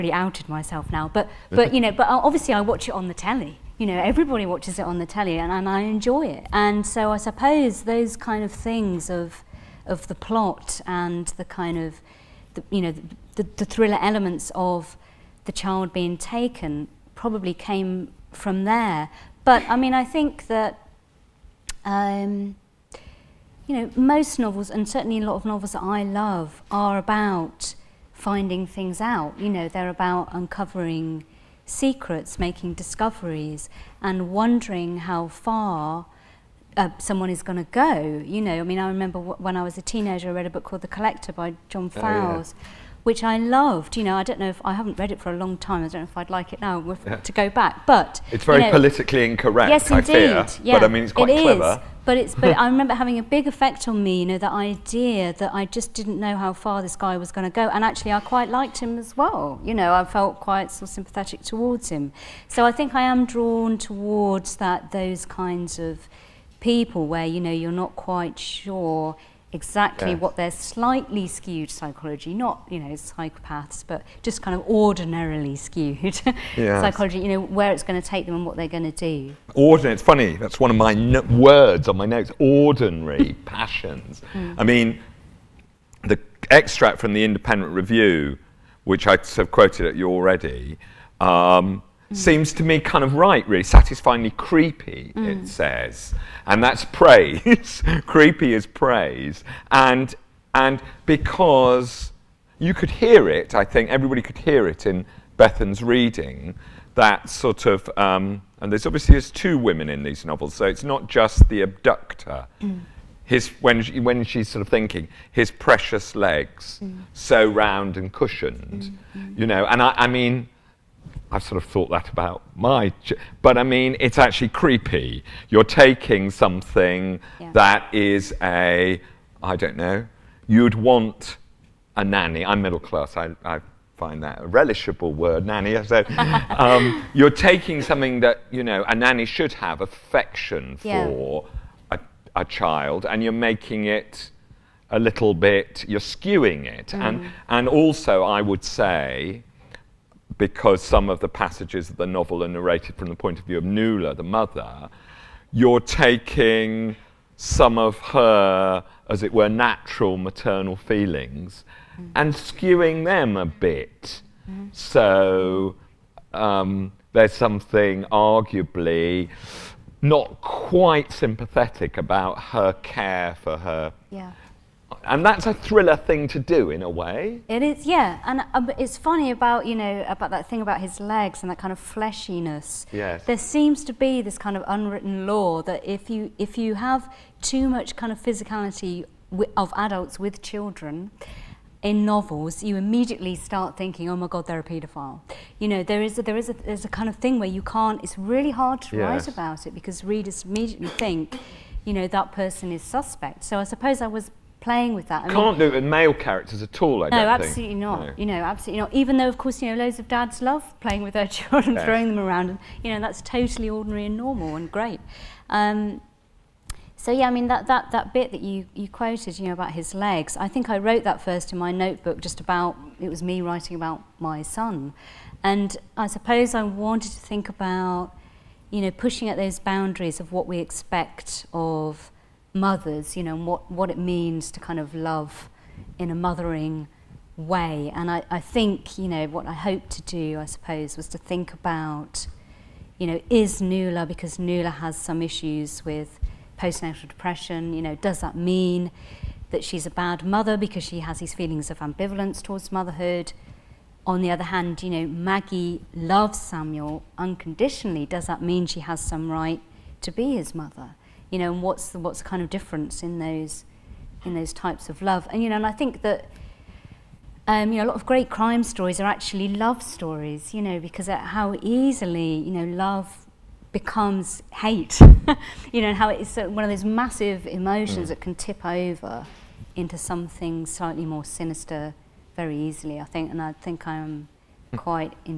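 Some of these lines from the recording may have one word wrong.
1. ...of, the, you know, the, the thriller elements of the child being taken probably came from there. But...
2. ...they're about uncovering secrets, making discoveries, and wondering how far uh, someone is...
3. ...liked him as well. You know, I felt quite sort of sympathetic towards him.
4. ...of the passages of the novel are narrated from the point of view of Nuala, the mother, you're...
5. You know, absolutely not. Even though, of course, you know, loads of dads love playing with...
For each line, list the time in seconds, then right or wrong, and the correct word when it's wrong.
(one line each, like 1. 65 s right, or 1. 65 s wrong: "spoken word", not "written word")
1. 11 s right
2. 29 s right
3. 58 s right
4. 151 s right
5. 208 s right.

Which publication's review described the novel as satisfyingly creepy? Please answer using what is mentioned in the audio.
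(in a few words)
The Independent Review.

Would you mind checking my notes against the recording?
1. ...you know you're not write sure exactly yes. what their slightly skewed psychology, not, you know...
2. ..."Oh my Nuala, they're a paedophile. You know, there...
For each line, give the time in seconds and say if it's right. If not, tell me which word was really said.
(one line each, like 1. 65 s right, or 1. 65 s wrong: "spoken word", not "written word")
1. 67 s wrong: "quite", not "write"
2. 194 s wrong: "God", not "Nuala".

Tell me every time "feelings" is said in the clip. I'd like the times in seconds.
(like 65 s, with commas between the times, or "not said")
160 s, 251 s.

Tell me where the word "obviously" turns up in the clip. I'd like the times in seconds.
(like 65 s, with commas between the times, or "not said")
2 s, 108 s.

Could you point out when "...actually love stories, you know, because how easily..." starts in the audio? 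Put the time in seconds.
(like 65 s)
269 s.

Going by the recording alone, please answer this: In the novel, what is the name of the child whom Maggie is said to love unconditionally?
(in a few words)
Samuel.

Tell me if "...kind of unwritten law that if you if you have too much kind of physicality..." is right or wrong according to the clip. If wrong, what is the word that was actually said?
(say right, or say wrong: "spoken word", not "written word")
right.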